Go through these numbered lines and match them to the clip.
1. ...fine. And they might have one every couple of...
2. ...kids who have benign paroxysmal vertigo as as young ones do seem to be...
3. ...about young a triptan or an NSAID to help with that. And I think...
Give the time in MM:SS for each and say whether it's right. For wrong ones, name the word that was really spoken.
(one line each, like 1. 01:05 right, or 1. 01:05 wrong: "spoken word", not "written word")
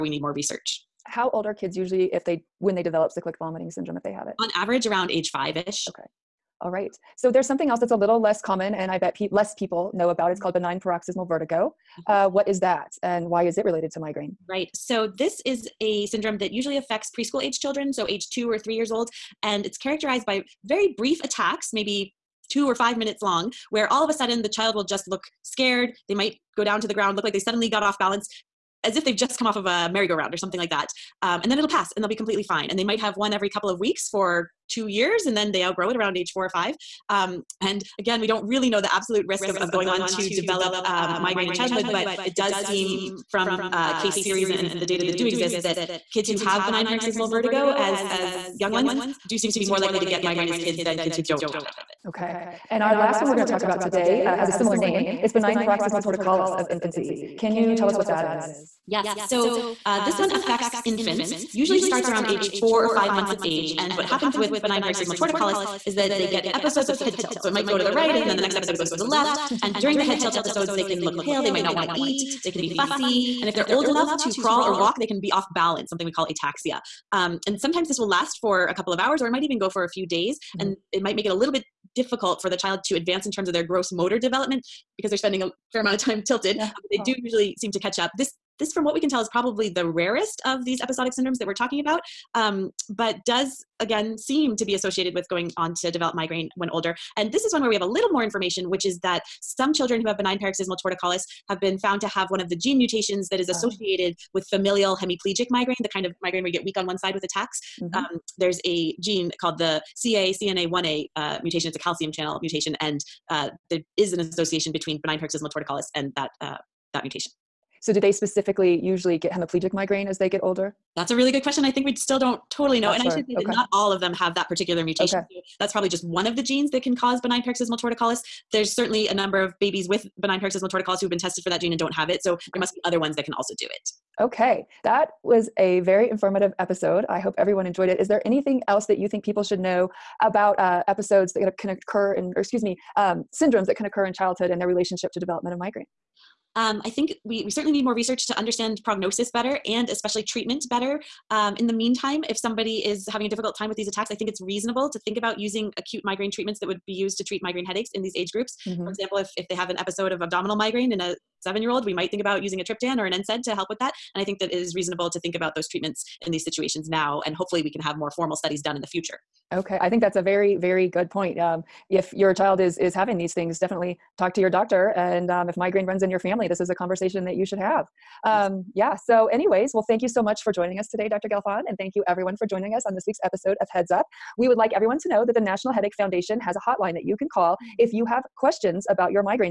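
1. 00:32 right
2. 00:46 right
3. 02:42 wrong: "using", not "young".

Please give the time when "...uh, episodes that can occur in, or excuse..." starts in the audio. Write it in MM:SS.
02:20.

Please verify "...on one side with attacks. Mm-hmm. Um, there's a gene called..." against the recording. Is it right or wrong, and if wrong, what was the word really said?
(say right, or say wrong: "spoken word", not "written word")
right.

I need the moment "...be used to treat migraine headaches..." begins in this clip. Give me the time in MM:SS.
02:36.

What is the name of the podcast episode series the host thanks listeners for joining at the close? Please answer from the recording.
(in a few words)
Heads Up.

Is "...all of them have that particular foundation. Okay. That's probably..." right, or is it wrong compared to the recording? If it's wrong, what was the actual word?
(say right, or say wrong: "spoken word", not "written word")
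wrong: "mutation", not "foundation".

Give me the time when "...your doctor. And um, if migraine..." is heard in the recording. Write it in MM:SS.
02:54.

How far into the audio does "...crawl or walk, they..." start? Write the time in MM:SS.
01:14.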